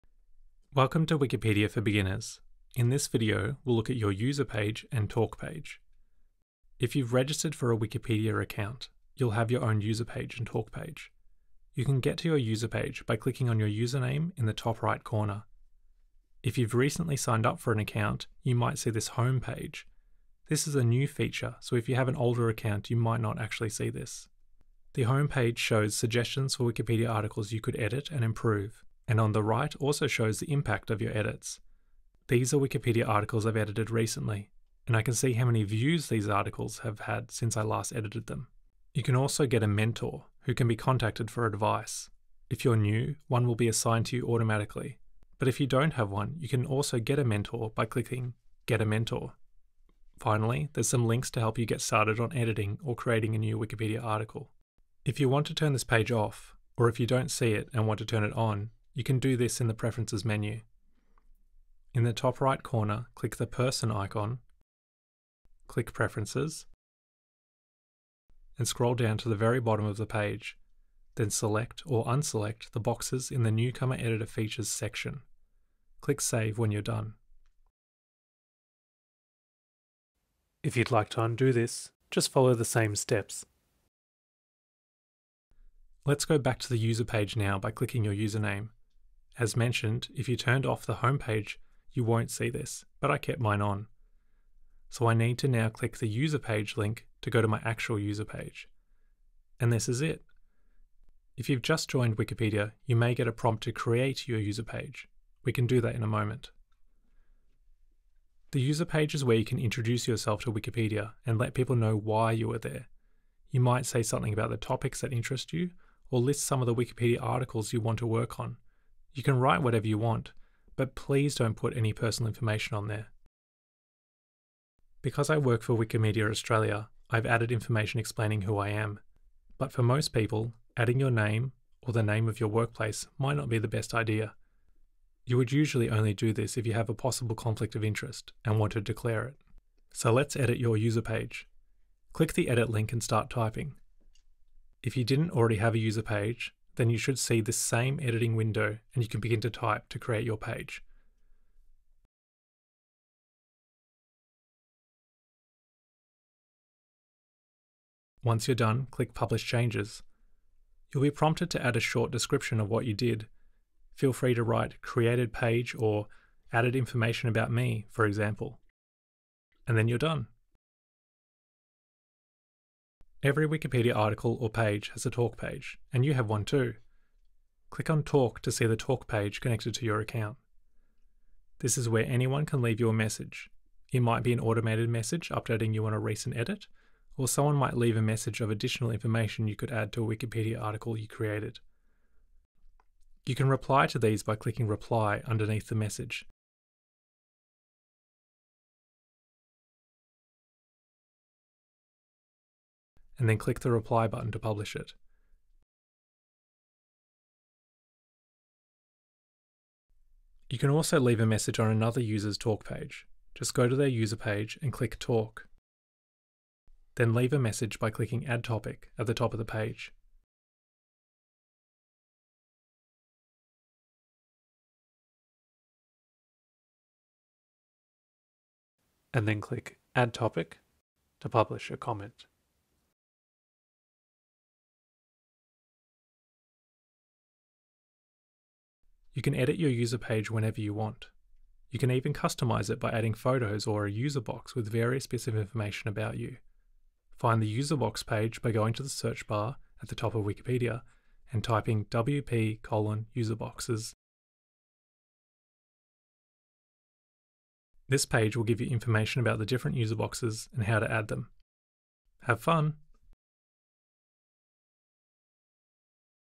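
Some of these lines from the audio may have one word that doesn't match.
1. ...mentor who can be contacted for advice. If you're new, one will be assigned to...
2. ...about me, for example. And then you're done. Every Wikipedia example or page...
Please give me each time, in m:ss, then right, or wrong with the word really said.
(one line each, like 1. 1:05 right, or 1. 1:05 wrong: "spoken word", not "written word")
1. 0:39 right
2. 2:47 wrong: "article", not "example".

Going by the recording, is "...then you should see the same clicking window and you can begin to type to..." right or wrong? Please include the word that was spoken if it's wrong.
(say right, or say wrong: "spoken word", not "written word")
wrong: "editing", not "clicking".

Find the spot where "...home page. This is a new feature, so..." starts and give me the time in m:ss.
0:19.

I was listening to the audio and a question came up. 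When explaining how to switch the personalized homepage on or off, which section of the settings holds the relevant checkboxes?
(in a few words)
Newcomer Editor Features.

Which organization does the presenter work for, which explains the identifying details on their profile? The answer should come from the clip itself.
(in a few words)
Wikimedia Australia.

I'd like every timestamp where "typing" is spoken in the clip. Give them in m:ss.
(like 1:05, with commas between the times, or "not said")
2:23, 4:11.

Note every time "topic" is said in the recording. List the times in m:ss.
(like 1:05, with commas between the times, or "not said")
1:54, 3:38, 3:50.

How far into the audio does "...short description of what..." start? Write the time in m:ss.
2:41.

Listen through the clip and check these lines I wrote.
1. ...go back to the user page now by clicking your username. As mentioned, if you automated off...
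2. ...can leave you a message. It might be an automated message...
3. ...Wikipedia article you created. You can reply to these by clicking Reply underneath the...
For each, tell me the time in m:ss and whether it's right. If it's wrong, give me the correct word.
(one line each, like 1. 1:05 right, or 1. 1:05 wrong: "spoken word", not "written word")
1. 1:26 wrong: "turned", not "automated"
2. 3:02 right
3. 3:10 right.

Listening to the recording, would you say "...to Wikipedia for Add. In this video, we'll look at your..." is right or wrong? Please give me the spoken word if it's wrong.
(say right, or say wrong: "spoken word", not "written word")
wrong: "Beginners", not "Add".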